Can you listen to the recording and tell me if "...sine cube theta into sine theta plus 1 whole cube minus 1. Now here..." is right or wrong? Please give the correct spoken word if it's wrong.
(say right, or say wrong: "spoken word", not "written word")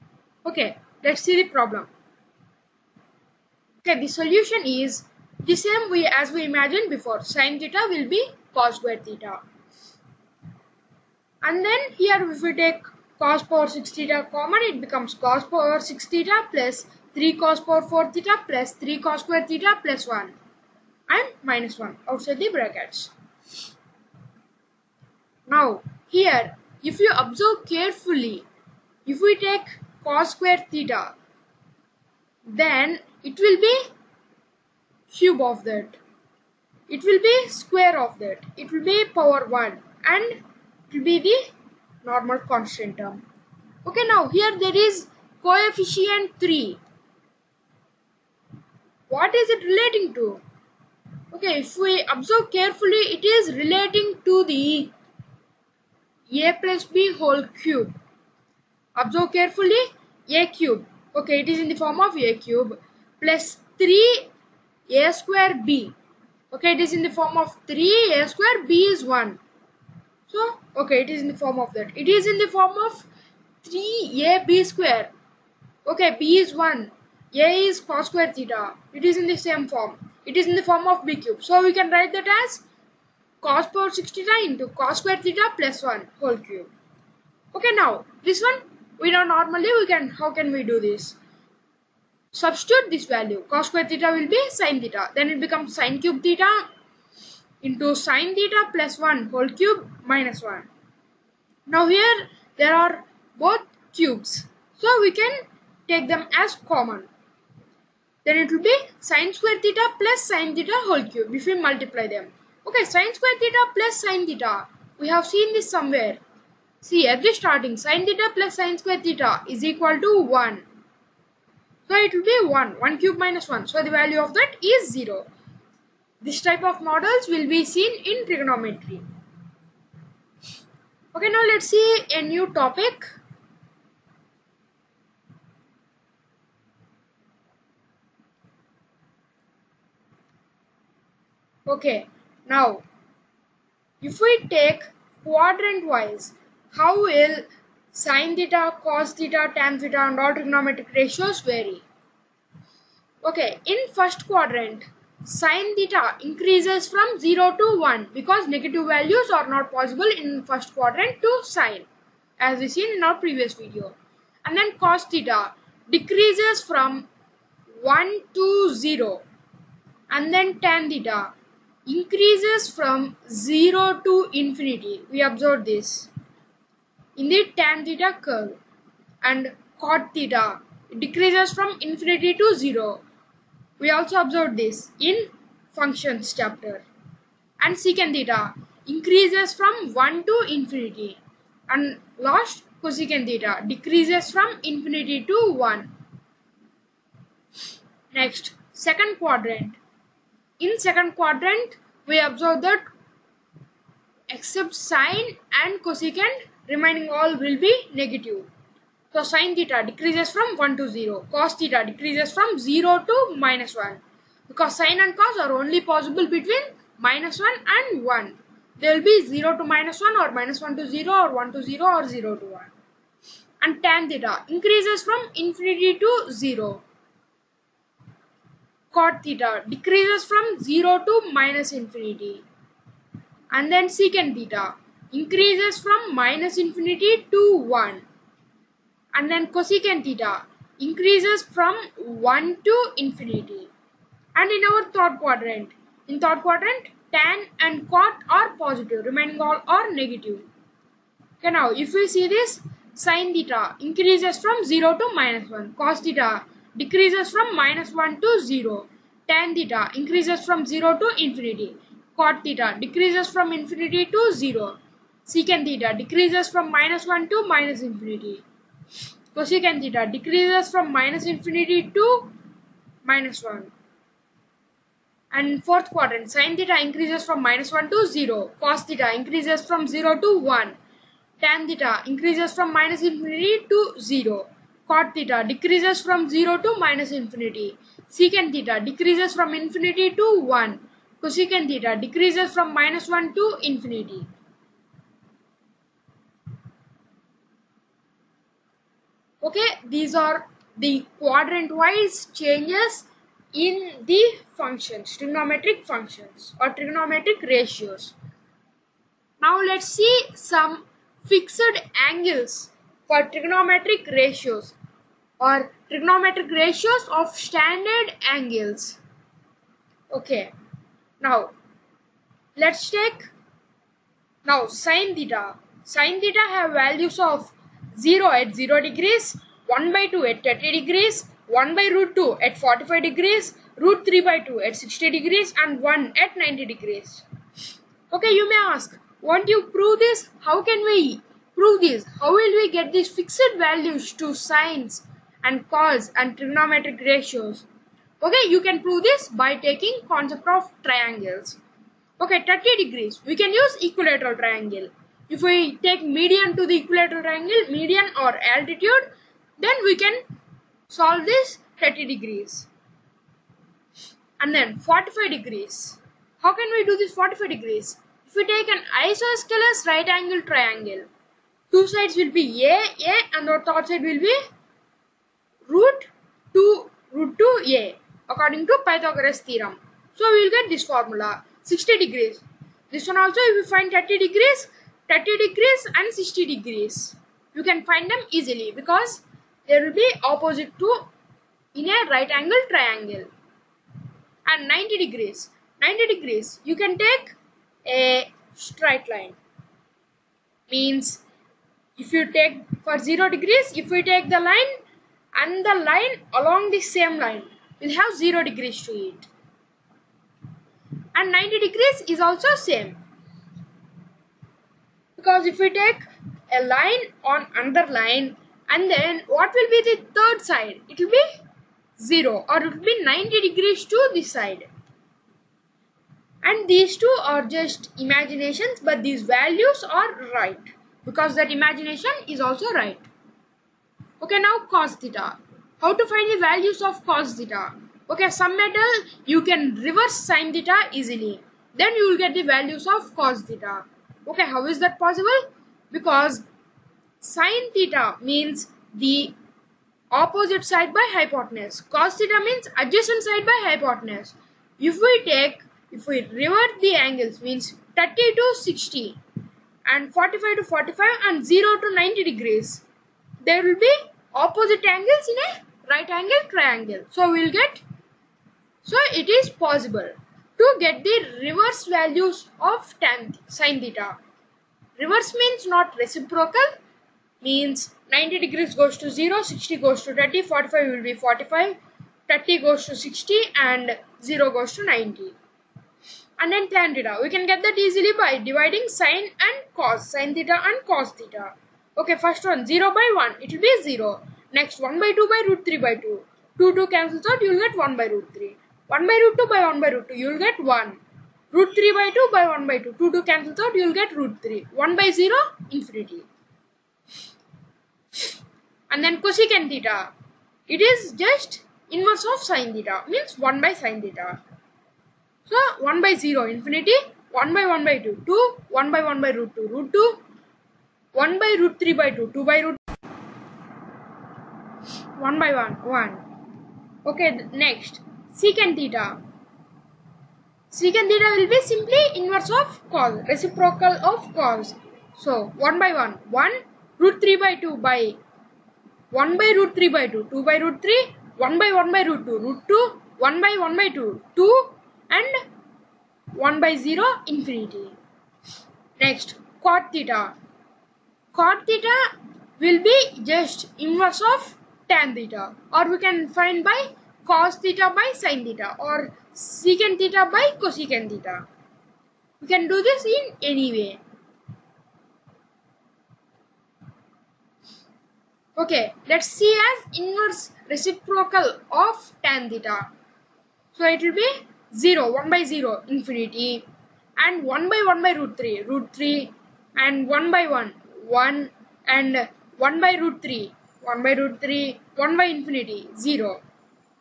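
right.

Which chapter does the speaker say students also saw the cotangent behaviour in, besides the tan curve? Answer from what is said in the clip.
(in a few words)
functions chapter.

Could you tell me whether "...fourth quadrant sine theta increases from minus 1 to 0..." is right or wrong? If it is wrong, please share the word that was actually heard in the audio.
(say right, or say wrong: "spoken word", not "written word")
right.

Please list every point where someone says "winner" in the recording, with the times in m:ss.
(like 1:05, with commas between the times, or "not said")
not said.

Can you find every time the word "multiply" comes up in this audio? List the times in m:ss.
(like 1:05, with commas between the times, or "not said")
1:51.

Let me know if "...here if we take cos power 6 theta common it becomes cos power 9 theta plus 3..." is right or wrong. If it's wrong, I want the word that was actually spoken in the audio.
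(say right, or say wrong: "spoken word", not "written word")
wrong: "6", not "9".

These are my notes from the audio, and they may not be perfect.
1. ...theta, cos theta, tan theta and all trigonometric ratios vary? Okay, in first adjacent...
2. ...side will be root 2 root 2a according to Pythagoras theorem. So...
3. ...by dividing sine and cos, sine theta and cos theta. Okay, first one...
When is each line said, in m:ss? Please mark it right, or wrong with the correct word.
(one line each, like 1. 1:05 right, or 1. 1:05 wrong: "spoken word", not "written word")
1. 2:28 wrong: "quadrant", not "adjacent"
2. 6:13 right
3. 8:08 right.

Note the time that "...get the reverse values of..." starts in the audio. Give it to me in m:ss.
7:50.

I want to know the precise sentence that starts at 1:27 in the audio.
Okay, now this one we know normally we can how can we do this?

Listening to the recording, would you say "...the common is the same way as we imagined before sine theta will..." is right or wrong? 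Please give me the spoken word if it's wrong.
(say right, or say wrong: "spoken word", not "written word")
wrong: "solution", not "common".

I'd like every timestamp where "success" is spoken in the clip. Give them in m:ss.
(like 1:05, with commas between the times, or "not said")
not said.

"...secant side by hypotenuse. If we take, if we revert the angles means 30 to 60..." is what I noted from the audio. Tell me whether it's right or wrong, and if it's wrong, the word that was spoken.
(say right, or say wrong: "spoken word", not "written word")
wrong: "adjacent", not "secant".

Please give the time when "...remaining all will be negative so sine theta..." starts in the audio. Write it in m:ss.
3:26.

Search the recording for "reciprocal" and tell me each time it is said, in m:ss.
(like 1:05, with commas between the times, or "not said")
7:55, 8:53, 9:30.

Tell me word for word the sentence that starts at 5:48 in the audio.
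Okay, you can prove this by taking concept of triangles.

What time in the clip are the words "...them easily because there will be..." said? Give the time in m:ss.
6:28.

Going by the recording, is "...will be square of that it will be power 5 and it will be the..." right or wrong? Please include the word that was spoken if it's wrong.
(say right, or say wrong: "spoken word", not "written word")
wrong: "1", not "5".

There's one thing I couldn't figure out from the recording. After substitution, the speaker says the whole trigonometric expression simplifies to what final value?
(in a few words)
0.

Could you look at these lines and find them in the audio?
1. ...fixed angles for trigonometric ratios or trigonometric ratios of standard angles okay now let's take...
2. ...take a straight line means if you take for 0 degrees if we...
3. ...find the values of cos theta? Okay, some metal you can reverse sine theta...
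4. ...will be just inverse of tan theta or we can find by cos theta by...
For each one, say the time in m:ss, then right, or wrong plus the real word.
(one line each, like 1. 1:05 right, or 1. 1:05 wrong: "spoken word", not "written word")
1. 5:11 right
2. 6:36 right
3. 7:16 right
4. 9:12 right.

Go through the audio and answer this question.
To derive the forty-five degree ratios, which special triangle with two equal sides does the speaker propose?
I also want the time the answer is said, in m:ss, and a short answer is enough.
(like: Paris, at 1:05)
isosceles right angle triangle, at 6:09.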